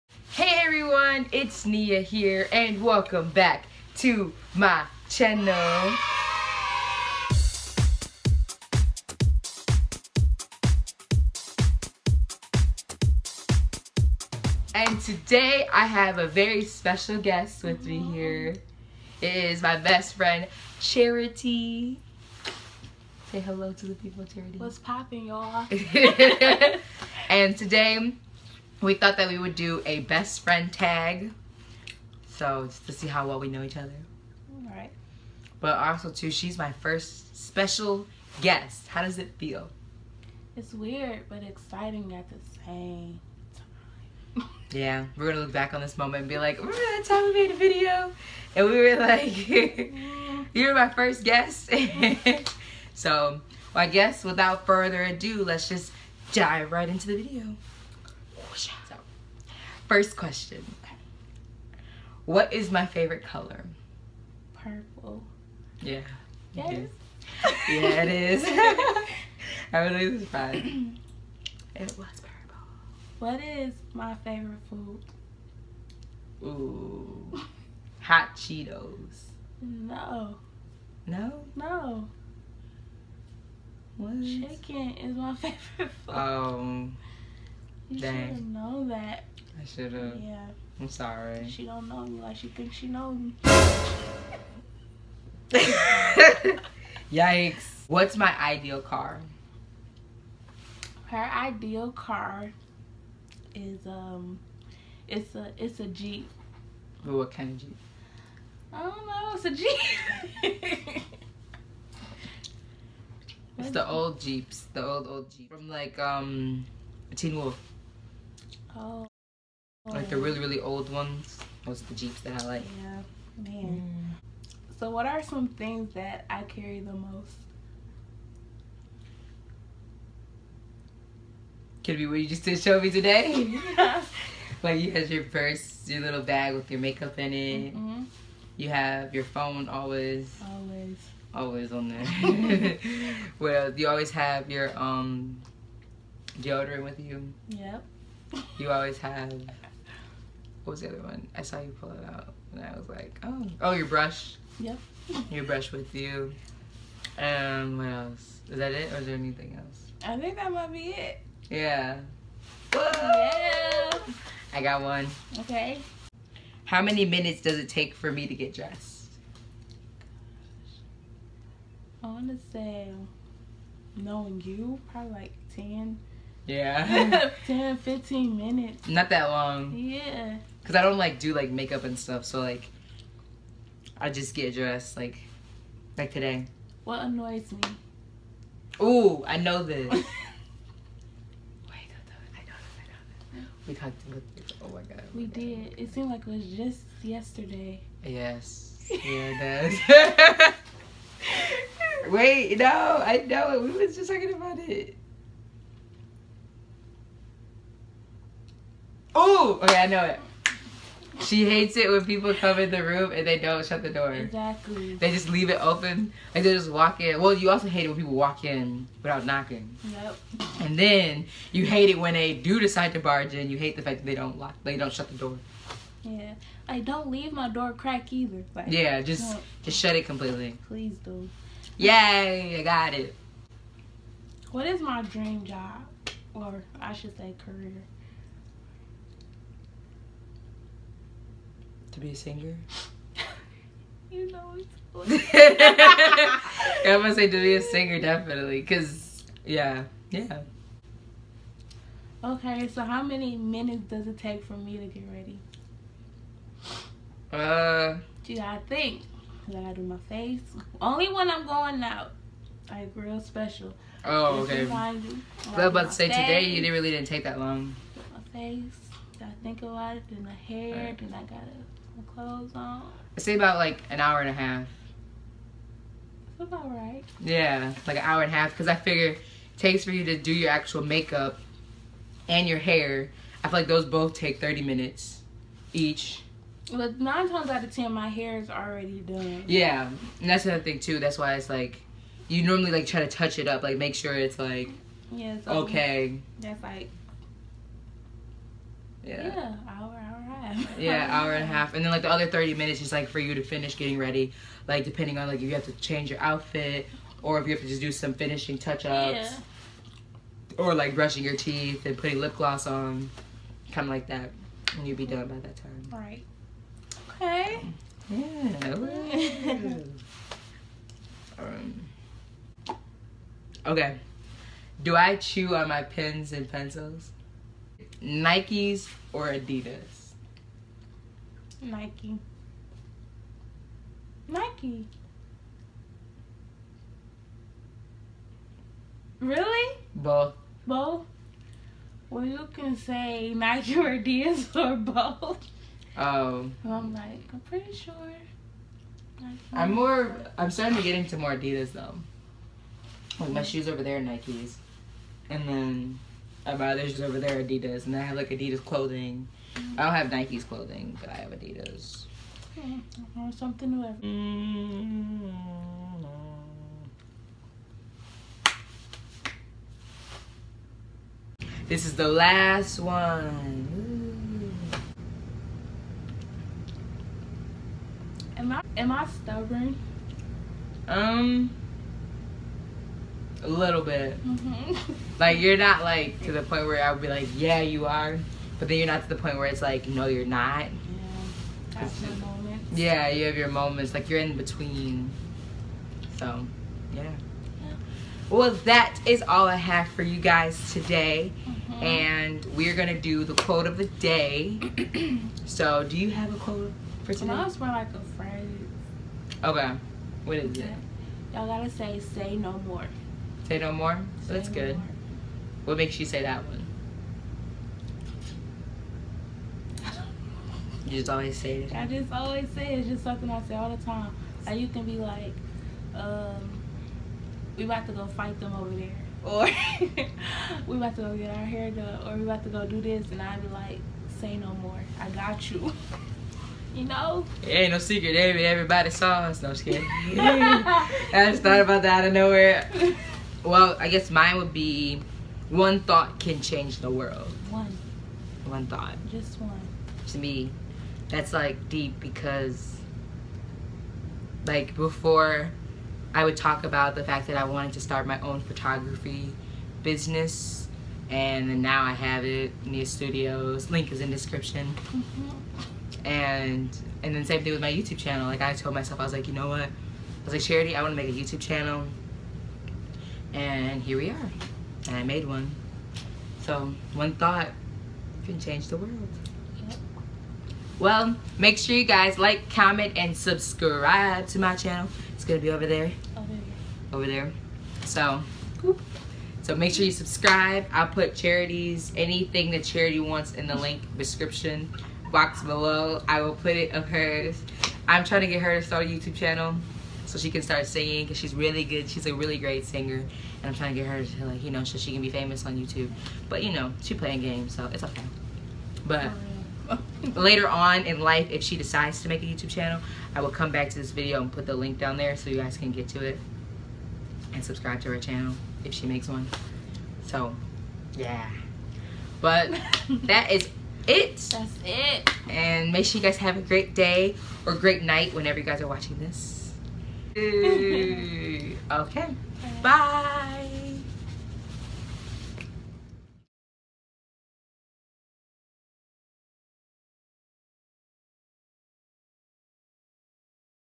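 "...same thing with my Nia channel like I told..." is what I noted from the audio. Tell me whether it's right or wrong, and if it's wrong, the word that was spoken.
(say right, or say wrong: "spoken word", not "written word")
wrong: "YouTube", not "Nia".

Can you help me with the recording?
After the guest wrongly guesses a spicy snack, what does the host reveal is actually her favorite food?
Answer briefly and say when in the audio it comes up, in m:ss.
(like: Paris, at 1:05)
Chicken, at 1:24.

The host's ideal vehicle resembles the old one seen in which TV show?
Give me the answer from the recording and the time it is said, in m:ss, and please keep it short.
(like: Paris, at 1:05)
Teen Wolf, at 1:57.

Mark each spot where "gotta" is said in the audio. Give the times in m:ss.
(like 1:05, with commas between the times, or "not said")
4:19, 4:31.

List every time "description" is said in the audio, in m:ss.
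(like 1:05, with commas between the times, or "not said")
7:44, 8:13.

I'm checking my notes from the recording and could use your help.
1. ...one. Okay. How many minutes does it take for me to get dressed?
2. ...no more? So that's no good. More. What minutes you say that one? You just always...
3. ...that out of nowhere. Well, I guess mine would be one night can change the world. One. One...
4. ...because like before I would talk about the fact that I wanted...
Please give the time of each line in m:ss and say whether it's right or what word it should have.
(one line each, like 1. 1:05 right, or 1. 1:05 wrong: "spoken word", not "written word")
1. 2:44 right
2. 6:53 wrong: "makes", not "minutes"
3. 7:21 wrong: "thought", not "night"
4. 7:31 right.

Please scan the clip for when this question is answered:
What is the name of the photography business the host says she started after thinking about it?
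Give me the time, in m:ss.
7:42.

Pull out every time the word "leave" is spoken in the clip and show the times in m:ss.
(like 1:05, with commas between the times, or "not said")
3:35, 3:47.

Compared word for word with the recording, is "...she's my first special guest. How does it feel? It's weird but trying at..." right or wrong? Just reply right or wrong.
wrong.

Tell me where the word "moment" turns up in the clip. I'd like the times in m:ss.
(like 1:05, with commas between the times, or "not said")
0:45, 6:33.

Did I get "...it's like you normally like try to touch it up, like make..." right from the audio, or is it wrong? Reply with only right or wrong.
right.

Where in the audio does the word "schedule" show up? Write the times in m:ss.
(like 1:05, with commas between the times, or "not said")
not said.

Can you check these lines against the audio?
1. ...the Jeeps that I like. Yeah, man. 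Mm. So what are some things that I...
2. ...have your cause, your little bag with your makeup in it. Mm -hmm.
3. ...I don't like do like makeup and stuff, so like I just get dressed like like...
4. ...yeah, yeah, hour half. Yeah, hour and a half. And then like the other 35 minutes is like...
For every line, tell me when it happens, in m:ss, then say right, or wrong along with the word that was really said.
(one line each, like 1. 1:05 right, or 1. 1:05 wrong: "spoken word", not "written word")
1. 2:01 right
2. 2:14 wrong: "purse", not "cause"
3. 3:00 right
4. 4:59 wrong: "30", not "35".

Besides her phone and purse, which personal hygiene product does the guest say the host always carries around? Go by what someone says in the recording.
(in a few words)
Deodorant.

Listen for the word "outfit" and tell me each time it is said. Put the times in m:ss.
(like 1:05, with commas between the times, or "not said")
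5:06.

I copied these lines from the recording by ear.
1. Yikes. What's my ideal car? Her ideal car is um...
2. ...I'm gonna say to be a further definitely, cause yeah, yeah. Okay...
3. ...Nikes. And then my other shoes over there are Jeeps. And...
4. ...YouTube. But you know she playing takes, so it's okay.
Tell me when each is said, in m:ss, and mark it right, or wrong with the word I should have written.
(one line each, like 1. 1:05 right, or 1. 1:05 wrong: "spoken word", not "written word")
1. 1:37 right
2. 4:06 wrong: "singer", not "further"
3. 5:54 wrong: "Adidas", not "Jeeps"
4. 8:25 wrong: "games", not "takes".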